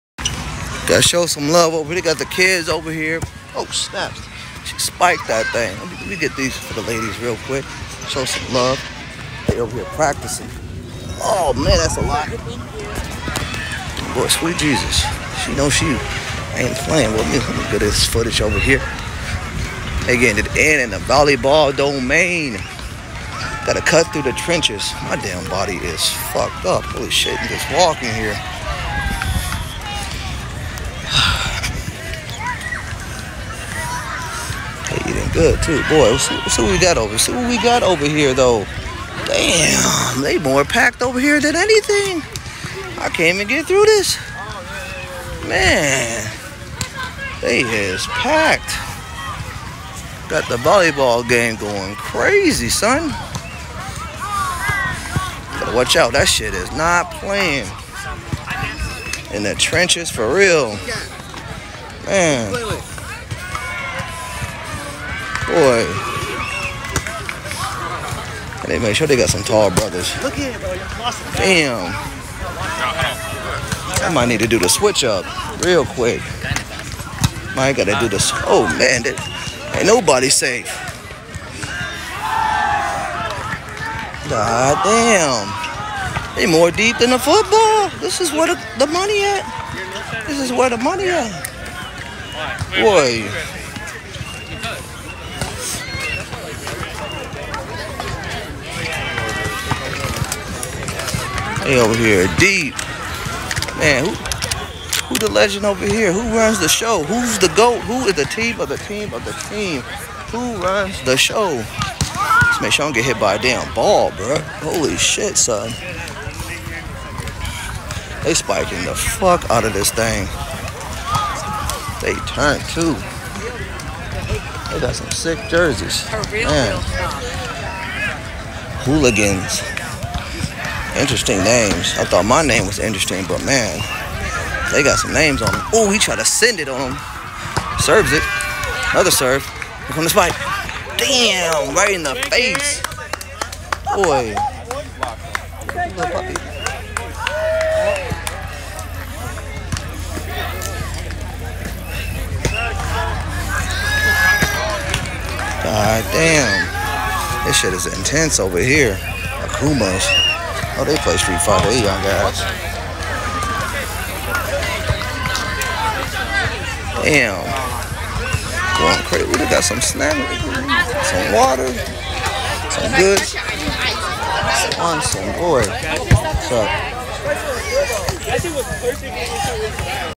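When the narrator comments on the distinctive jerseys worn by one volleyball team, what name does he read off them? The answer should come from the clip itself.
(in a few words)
Hooligans.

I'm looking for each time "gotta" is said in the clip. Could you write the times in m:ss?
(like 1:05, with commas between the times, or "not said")
0:00, 0:23, 0:55, 1:17.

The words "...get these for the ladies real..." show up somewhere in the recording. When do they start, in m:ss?
0:06.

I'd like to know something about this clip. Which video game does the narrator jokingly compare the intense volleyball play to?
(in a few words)
Street Fighter.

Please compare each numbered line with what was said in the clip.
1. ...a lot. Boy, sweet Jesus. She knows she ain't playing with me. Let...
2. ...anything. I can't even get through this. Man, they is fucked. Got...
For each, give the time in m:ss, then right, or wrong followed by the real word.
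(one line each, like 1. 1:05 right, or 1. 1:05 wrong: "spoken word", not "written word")
1. 0:11 right
2. 0:41 wrong: "packed", not "fucked".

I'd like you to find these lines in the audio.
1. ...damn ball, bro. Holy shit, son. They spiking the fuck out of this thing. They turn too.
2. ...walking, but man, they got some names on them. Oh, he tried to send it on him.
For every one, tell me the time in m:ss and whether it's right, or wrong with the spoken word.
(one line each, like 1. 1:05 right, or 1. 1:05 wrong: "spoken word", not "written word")
1. 1:53 right
2. 2:12 wrong: "interesting", not "walking".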